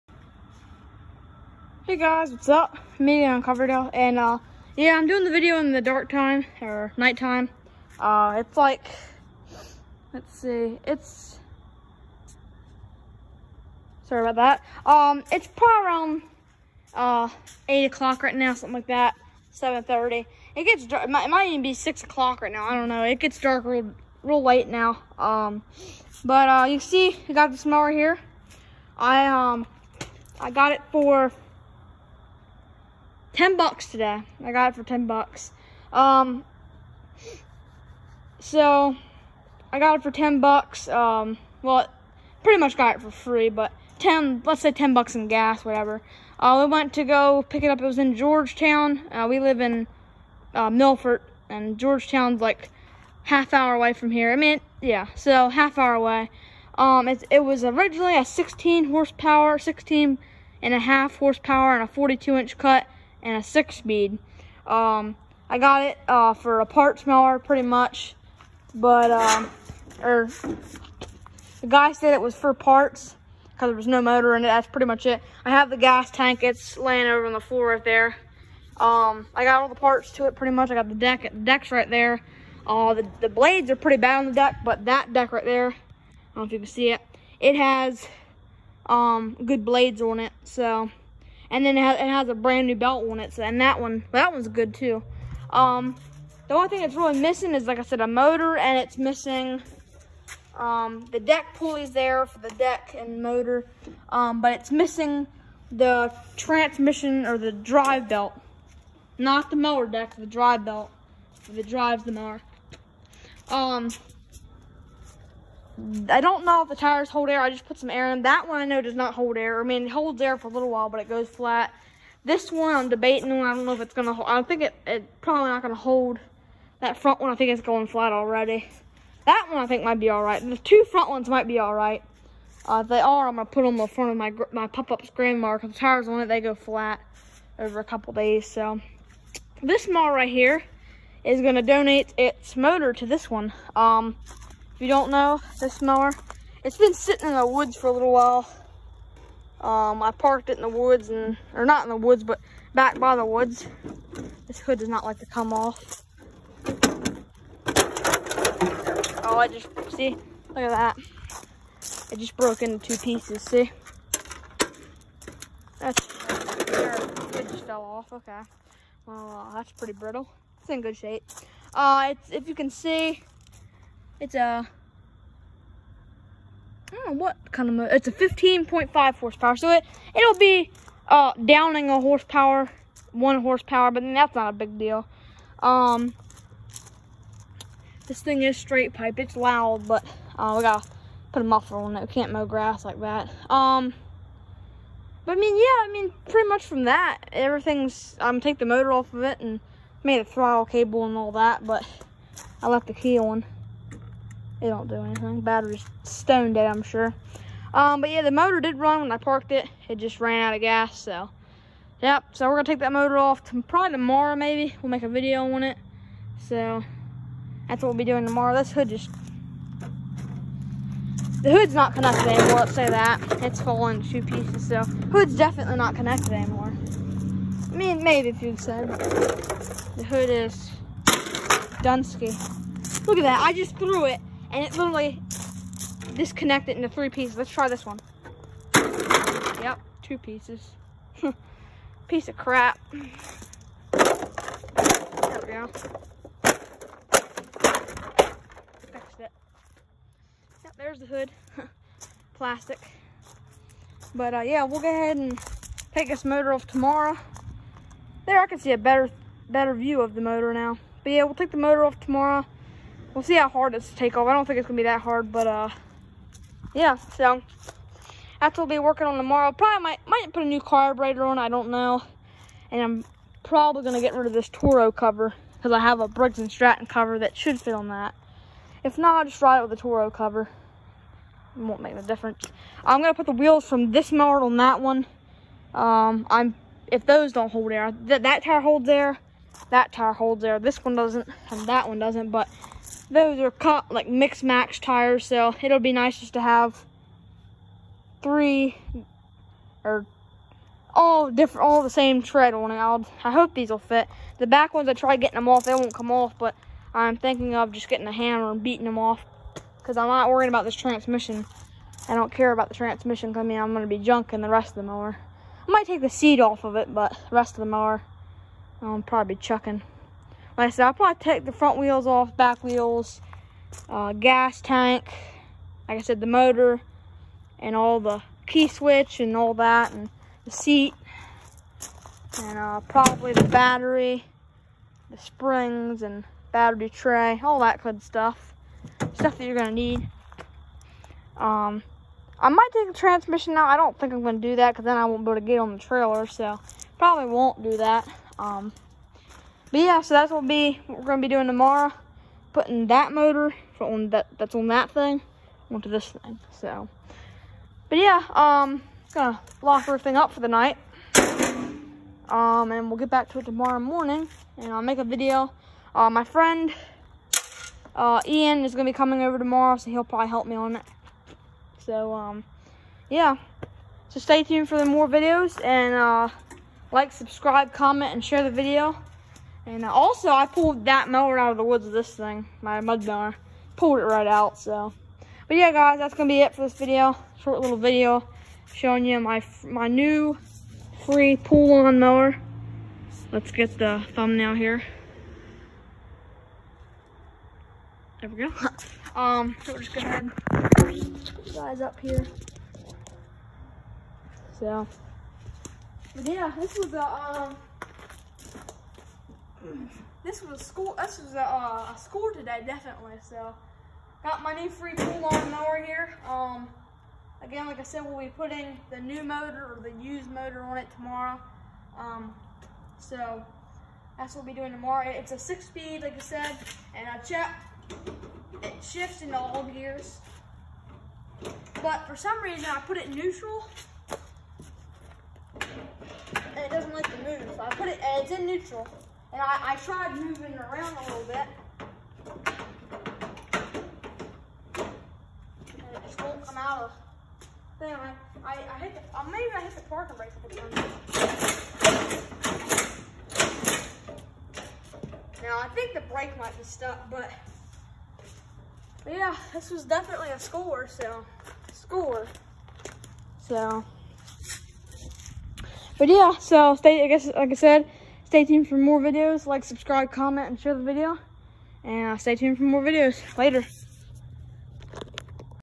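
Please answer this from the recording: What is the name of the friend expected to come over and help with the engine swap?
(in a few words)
Ian.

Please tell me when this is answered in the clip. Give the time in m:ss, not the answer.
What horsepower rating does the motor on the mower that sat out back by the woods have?
2:58.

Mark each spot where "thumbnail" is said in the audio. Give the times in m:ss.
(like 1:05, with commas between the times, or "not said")
6:34.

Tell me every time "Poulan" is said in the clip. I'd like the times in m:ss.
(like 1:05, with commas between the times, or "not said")
6:31, 6:54.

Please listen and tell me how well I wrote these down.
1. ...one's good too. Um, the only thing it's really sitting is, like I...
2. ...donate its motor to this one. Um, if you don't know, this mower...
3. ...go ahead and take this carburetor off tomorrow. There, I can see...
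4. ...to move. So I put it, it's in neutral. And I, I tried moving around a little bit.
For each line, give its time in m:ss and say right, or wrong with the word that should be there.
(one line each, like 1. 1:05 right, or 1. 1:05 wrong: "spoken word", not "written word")
1. 1:34 wrong: "missing", not "sitting"
2. 2:21 right
3. 4:14 wrong: "motor", not "carburetor"
4. 7:17 right.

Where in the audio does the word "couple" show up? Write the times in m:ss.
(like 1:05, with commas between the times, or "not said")
2:17, 7:30.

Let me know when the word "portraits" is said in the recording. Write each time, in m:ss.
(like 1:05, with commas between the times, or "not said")
not said.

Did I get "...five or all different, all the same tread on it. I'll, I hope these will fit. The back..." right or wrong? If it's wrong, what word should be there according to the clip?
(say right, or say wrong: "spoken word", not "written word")
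wrong: "three", not "five".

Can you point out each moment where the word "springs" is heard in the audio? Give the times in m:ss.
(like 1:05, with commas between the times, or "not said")
5:35.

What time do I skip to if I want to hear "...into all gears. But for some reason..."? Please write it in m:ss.
7:09.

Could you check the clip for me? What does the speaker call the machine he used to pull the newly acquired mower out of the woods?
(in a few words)
mud mower.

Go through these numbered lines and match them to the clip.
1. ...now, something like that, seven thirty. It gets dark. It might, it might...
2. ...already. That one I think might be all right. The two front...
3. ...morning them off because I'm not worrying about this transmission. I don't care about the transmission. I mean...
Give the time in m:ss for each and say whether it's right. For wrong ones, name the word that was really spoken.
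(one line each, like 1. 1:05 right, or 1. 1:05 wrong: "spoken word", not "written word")
1. 0:18 right
2. 2:08 right
3. 5:08 wrong: "beating", not "morning".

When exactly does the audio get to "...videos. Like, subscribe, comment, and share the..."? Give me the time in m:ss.
7:49.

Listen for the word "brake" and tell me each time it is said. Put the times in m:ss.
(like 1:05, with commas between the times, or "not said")
7:30, 7:36.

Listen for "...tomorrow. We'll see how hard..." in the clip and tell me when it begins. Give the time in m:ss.
4:22.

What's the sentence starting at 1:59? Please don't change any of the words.
I mean, it holds air for a little while, but it goes flat.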